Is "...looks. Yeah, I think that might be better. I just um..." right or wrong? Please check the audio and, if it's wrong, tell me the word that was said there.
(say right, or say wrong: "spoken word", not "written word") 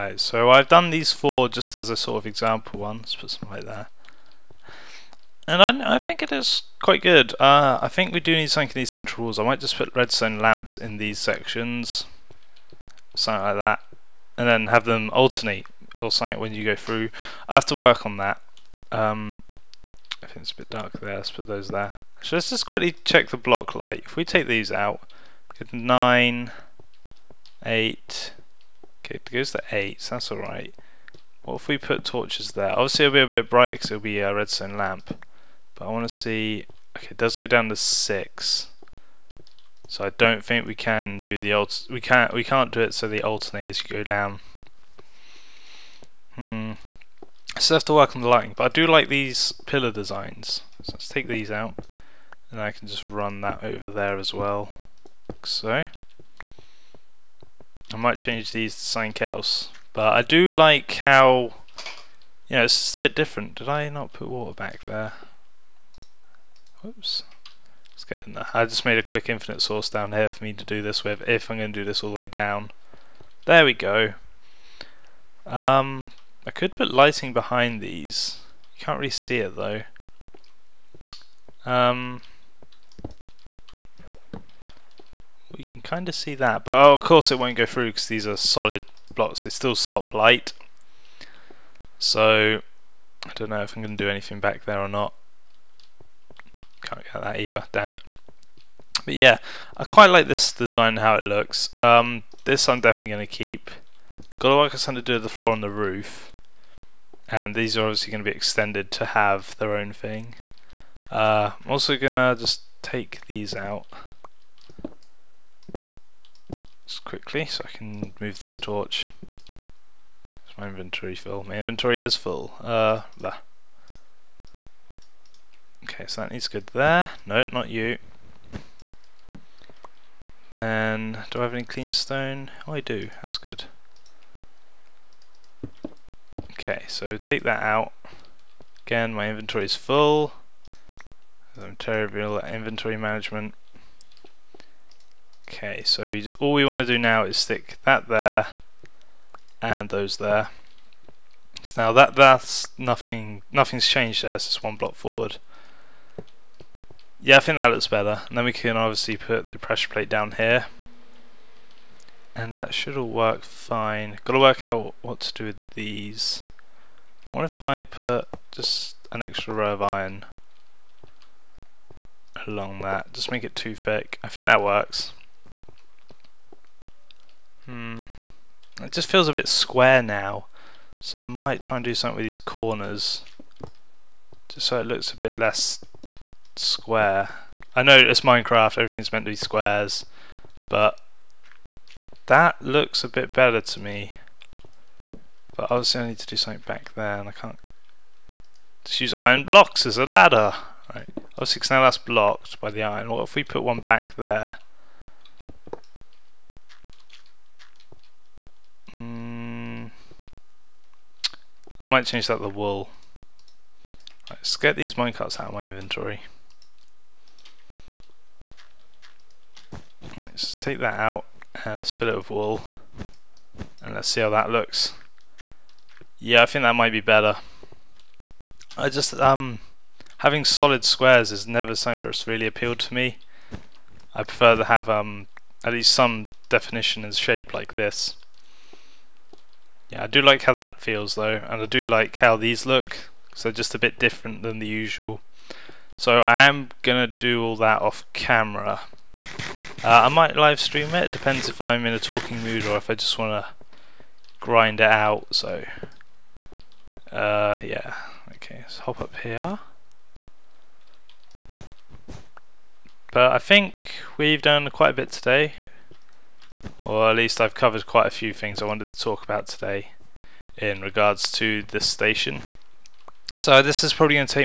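right.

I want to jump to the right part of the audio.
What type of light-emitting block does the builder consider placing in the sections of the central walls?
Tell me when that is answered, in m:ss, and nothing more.
0:09.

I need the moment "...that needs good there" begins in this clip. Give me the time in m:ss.
2:06.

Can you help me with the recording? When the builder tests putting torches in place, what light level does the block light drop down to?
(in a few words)
6.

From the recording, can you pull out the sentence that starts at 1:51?
Uh, I'm also going to just take these out just quickly so I can move this torch.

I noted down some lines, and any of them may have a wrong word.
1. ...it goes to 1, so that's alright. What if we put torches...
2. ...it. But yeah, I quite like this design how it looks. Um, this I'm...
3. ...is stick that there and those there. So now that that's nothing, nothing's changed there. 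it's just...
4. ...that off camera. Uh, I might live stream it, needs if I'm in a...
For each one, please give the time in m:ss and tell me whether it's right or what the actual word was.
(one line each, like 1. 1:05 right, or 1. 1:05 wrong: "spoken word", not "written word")
1. 0:29 wrong: "8", not "1"
2. 1:37 right
3. 2:27 right
4. 4:07 wrong: "depends", not "needs".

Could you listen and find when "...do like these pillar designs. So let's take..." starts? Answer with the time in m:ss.
0:48.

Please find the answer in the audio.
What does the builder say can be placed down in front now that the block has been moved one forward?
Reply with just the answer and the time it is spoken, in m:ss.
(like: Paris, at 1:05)
Pressure plate, at 2:39.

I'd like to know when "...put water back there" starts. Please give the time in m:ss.
1:04.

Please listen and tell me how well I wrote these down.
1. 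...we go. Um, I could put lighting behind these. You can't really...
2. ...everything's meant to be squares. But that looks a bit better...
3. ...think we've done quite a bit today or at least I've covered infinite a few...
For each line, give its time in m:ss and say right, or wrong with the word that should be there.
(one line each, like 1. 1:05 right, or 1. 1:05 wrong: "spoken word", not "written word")
1. 1:13 right
2. 3:08 right
3. 4:23 wrong: "quite", not "infinite".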